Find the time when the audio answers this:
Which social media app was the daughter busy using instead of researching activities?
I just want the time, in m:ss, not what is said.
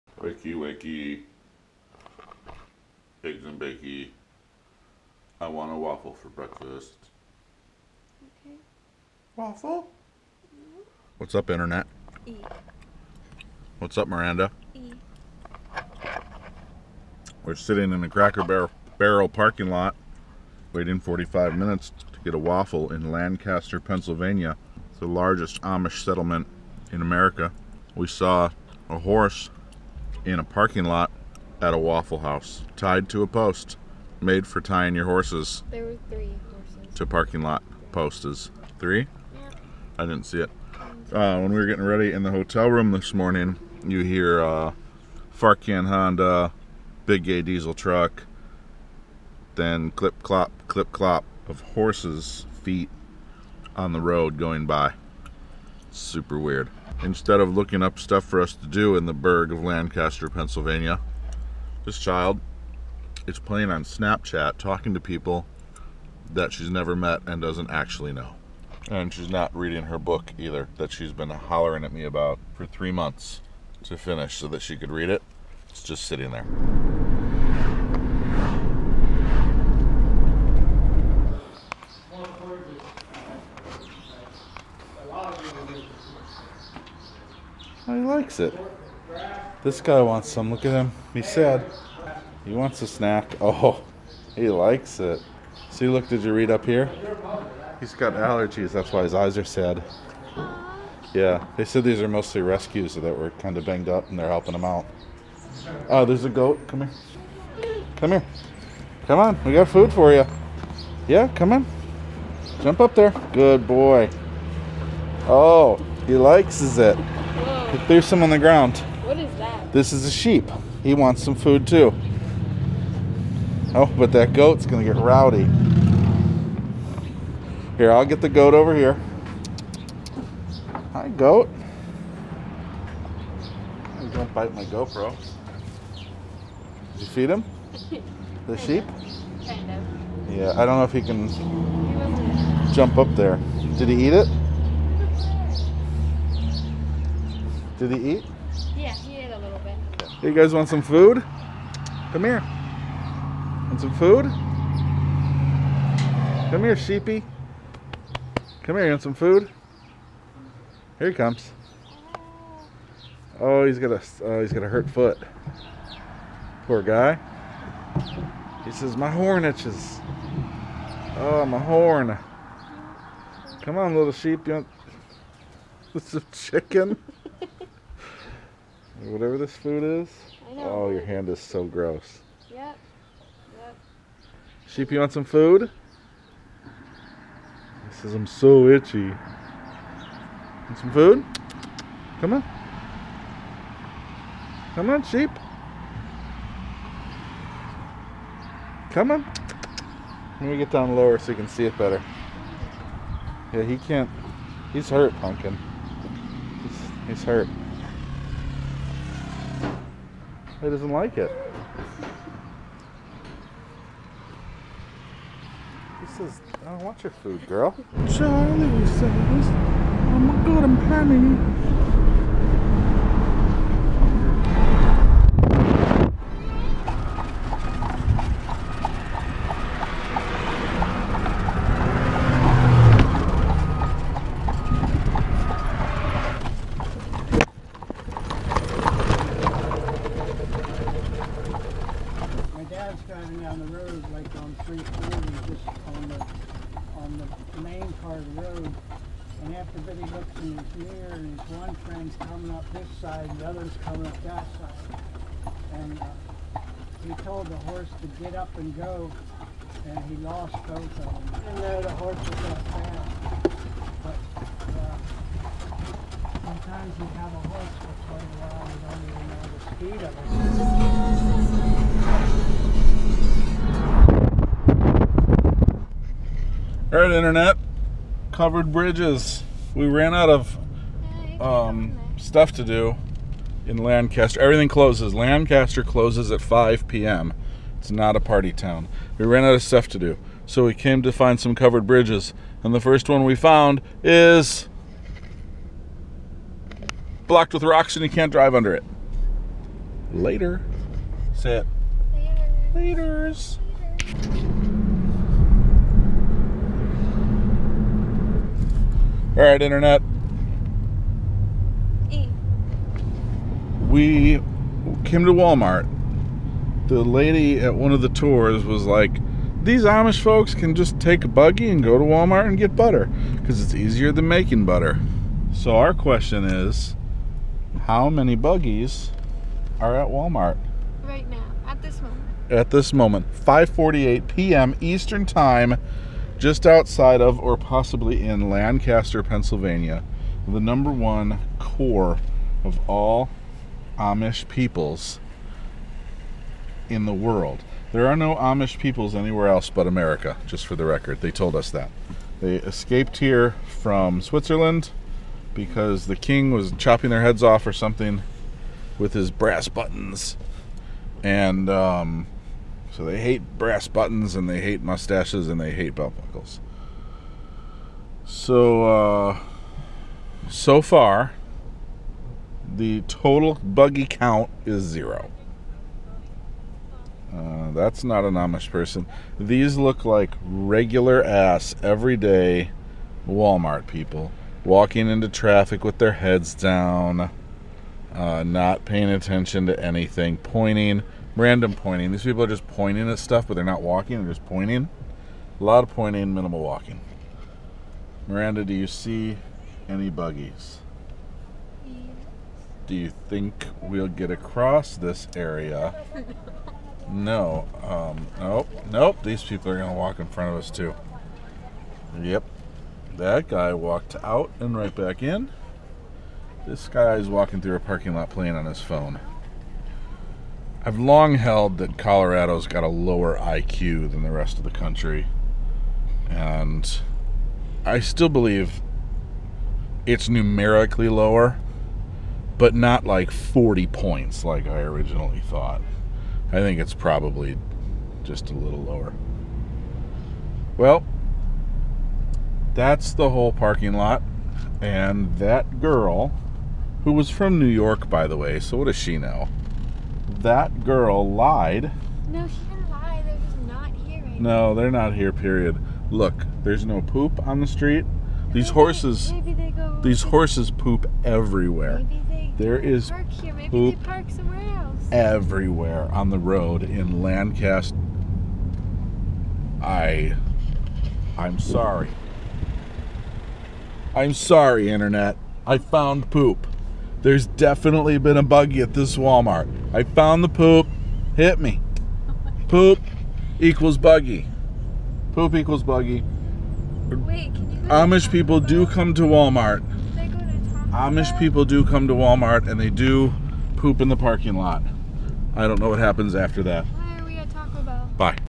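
1:03.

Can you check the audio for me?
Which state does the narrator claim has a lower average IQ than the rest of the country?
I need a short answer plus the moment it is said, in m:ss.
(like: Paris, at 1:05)
Colorado, at 7:01.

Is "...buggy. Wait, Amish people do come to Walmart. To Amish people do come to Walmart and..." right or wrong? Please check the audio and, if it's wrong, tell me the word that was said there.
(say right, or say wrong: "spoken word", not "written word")
right.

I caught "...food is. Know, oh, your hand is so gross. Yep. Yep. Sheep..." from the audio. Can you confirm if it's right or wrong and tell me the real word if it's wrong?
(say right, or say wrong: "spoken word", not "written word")
right.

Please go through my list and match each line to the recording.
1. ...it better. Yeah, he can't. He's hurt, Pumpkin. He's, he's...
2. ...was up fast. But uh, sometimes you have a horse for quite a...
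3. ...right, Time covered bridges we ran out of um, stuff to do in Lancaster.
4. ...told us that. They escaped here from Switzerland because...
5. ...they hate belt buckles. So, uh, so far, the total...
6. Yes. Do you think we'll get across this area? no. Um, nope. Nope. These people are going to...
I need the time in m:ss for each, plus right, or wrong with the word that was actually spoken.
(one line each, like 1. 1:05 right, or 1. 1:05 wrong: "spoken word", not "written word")
1. 3:21 right
2. 4:22 right
3. 4:36 wrong: "Internet", not "Time"
4. 5:51 right
5. 6:05 right
6. 6:41 right.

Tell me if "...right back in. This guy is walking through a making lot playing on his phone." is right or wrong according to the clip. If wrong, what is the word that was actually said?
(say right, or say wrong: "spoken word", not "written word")
wrong: "parking", not "making".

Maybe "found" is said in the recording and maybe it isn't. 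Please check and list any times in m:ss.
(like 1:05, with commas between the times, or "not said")
4:53, 7:55, 8:00.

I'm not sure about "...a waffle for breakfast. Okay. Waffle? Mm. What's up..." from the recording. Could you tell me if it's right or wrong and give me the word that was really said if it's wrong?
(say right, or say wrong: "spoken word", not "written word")
right.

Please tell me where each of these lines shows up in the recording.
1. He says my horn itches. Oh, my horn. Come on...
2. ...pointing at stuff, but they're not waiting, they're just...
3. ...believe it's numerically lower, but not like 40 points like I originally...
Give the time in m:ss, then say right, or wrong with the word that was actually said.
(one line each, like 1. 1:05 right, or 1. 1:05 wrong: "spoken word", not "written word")
1. 2:48 right
2. 6:32 wrong: "walking", not "waiting"
3. 7:08 right.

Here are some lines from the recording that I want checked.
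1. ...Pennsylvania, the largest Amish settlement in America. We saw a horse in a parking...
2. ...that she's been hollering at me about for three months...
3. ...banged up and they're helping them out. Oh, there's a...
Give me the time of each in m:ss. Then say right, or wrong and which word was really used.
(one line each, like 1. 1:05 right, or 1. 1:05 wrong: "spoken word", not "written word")
1. 0:23 right
2. 1:10 right
3. 1:43 right.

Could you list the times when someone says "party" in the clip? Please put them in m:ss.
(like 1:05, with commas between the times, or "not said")
4:48.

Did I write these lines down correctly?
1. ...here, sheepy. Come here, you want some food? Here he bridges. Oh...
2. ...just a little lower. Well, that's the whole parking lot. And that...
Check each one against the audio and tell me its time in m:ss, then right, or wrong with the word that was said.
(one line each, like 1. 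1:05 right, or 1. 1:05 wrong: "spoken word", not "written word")
1. 2:36 wrong: "comes", not "bridges"
2. 7:18 right.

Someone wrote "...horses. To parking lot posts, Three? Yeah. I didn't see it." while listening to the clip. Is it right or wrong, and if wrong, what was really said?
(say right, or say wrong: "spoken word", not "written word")
right.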